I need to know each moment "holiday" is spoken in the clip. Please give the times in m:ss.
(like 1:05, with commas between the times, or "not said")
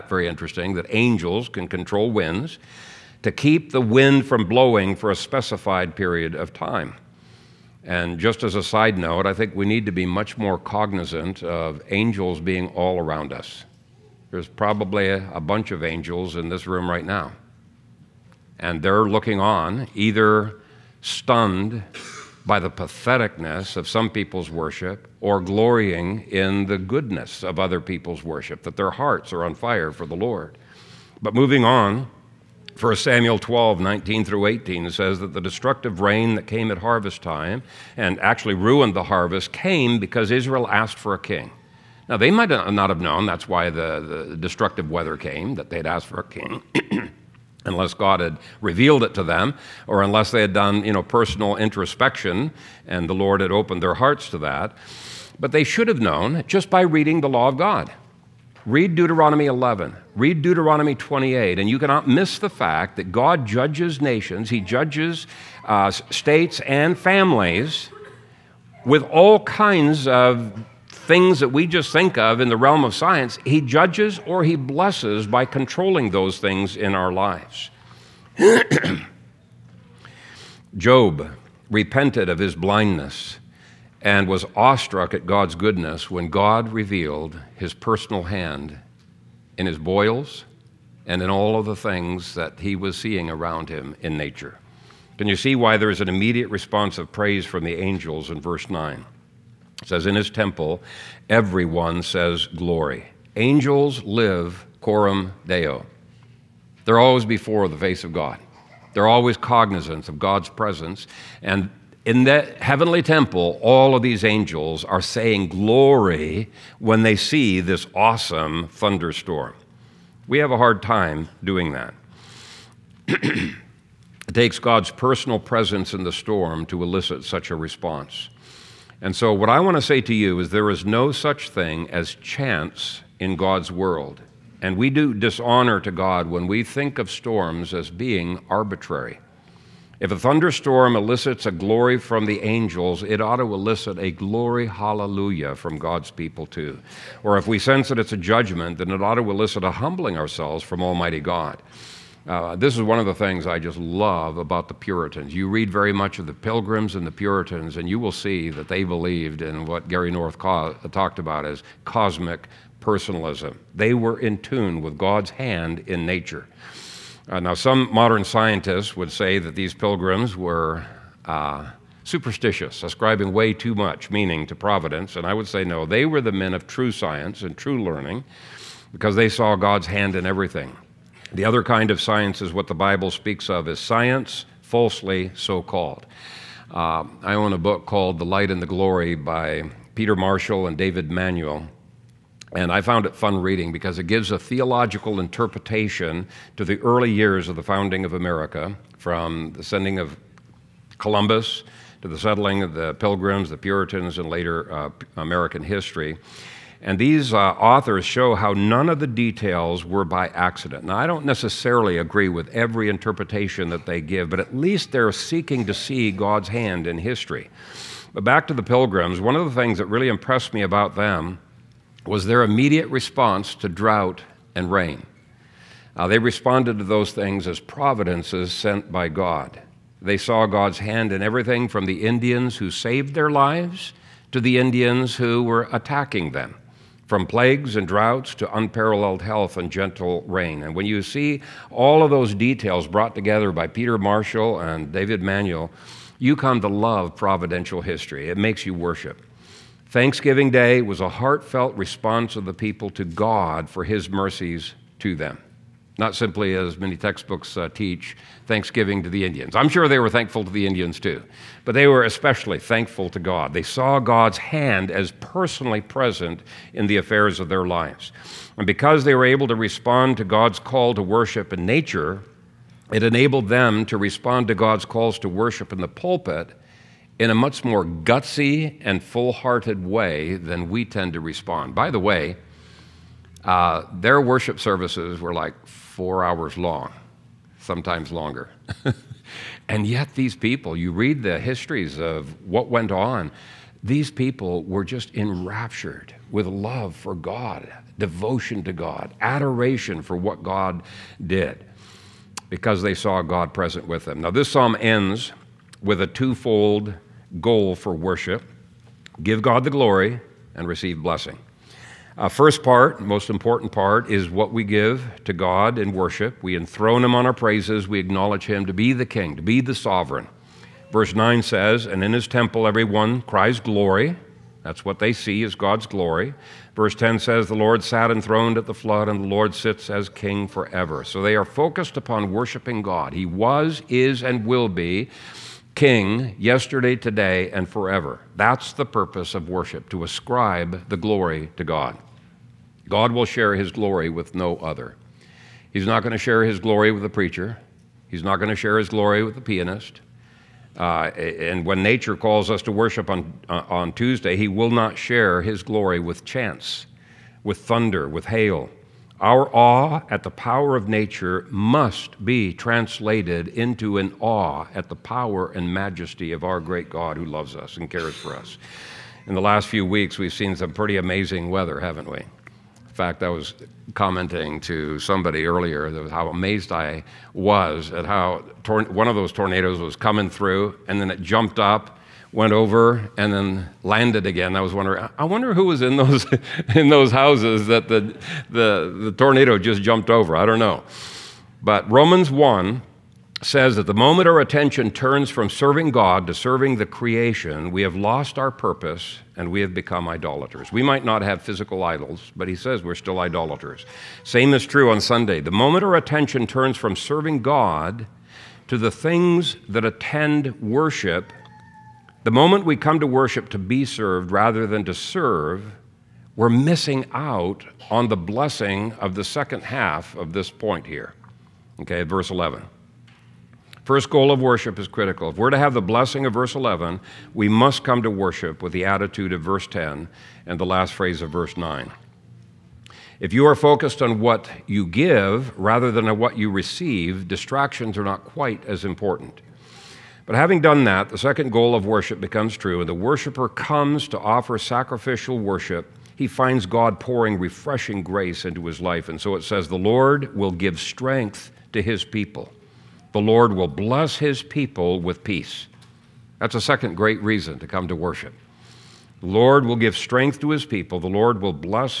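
not said.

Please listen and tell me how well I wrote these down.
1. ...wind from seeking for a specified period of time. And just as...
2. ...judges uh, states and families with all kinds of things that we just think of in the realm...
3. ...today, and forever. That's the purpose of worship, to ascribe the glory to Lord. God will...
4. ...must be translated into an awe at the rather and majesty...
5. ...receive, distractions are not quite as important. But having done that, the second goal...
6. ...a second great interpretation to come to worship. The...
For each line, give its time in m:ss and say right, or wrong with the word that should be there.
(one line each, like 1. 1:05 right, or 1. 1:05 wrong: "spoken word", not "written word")
1. 0:03 wrong: "blowing", not "seeking"
2. 1:04 right
3. 5:36 wrong: "God", not "Lord"
4. 6:01 wrong: "power", not "rather"
5. 7:16 right
6. 7:36 wrong: "reason", not "interpretation".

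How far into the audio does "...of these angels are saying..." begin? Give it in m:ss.
1:53.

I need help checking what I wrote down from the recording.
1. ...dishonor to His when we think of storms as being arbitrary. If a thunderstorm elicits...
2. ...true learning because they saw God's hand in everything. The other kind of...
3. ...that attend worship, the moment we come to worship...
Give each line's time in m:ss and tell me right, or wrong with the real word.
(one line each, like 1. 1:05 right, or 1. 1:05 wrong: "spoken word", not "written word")
1. 2:15 wrong: "God", not "His"
2. 2:57 right
3. 6:49 right.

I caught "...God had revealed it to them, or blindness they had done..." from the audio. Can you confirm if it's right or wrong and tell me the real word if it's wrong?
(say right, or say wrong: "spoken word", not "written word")
wrong: "unless", not "blindness".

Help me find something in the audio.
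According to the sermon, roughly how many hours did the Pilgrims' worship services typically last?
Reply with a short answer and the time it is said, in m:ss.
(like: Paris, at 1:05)
4, at 4:45.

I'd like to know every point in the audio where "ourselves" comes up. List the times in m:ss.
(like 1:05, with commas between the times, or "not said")
2:30.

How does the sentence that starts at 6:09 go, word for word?
In the last few weeks, we've seen some pretty amazing weather, haven't we?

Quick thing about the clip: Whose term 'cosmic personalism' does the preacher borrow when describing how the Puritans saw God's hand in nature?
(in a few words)
Gary North.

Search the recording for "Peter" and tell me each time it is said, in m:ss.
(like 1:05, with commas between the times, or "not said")
3:09, 4:03.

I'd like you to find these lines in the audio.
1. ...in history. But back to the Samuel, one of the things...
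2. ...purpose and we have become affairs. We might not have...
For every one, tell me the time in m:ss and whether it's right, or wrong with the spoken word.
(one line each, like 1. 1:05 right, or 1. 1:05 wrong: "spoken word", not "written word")
1. 3:36 wrong: "Pilgrims", not "Samuel"
2. 6:38 wrong: "idolaters", not "affairs".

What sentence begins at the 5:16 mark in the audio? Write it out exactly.
We enthrone Him on our praises.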